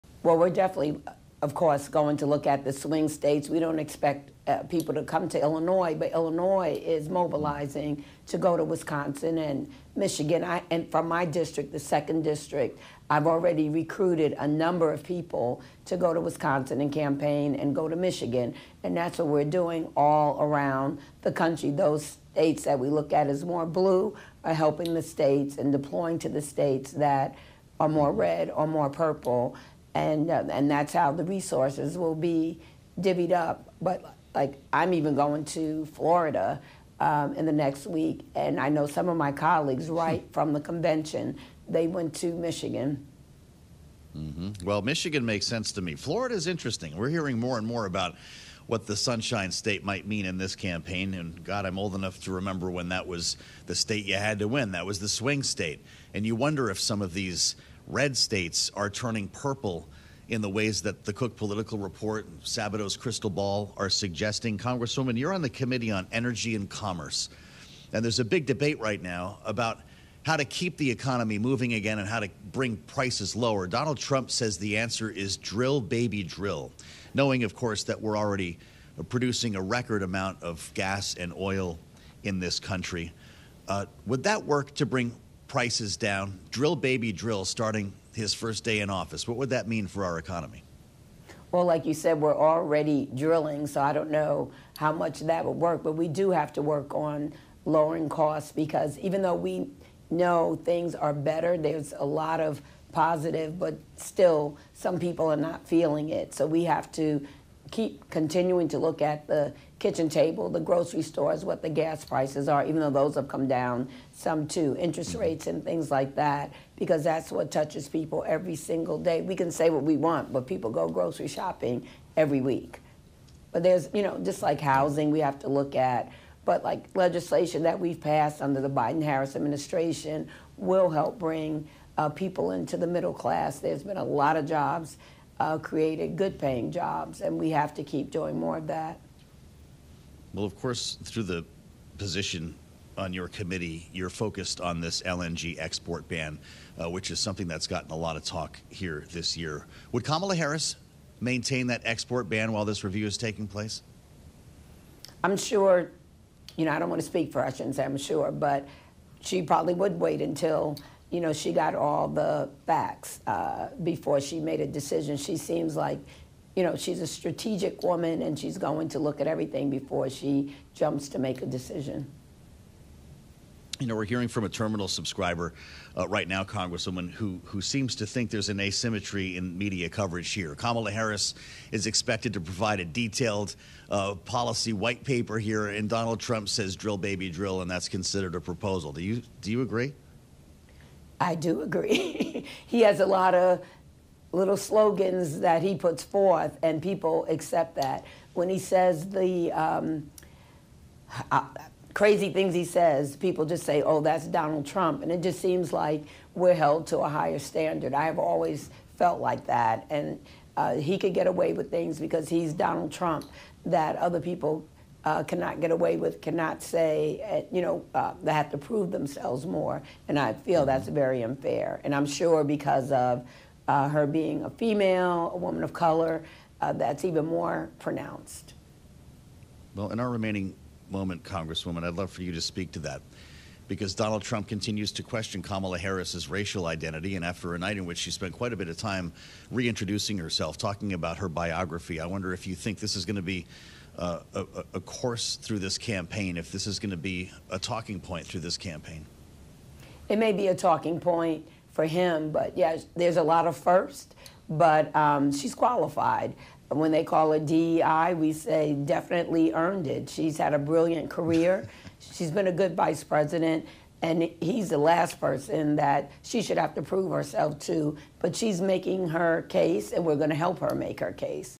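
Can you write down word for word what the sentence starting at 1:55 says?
rates and things like that, because that's what touches people every single day.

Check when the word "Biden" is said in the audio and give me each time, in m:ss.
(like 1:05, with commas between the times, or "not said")
2:08.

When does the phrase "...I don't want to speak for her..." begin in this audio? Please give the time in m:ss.
2:36.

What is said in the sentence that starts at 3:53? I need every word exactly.
Because Donald Trump continues to question Kamala Harris's racial identity.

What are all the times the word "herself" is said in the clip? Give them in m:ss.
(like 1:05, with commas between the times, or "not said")
4:00, 4:27.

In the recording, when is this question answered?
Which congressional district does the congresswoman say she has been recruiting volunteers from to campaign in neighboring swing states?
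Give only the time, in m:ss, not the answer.
0:11.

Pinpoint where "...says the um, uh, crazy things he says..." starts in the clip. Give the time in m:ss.
3:18.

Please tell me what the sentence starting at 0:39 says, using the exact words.
right from the convention they went to Michigan.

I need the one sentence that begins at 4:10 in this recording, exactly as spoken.
It may be a talking point for him, but yeah, there's a lot of first, but um, she's qualified.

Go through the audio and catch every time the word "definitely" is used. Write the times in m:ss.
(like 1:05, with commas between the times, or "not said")
0:00, 4:18.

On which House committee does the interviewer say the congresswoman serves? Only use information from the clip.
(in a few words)
Energy and Commerce.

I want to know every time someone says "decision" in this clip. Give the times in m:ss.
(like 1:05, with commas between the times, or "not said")
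2:44, 2:51.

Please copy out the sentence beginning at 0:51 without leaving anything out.
And God, I'm old enough to remember when that was the state you had to win.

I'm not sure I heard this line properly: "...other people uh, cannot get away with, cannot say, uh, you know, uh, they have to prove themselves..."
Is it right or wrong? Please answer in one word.
right.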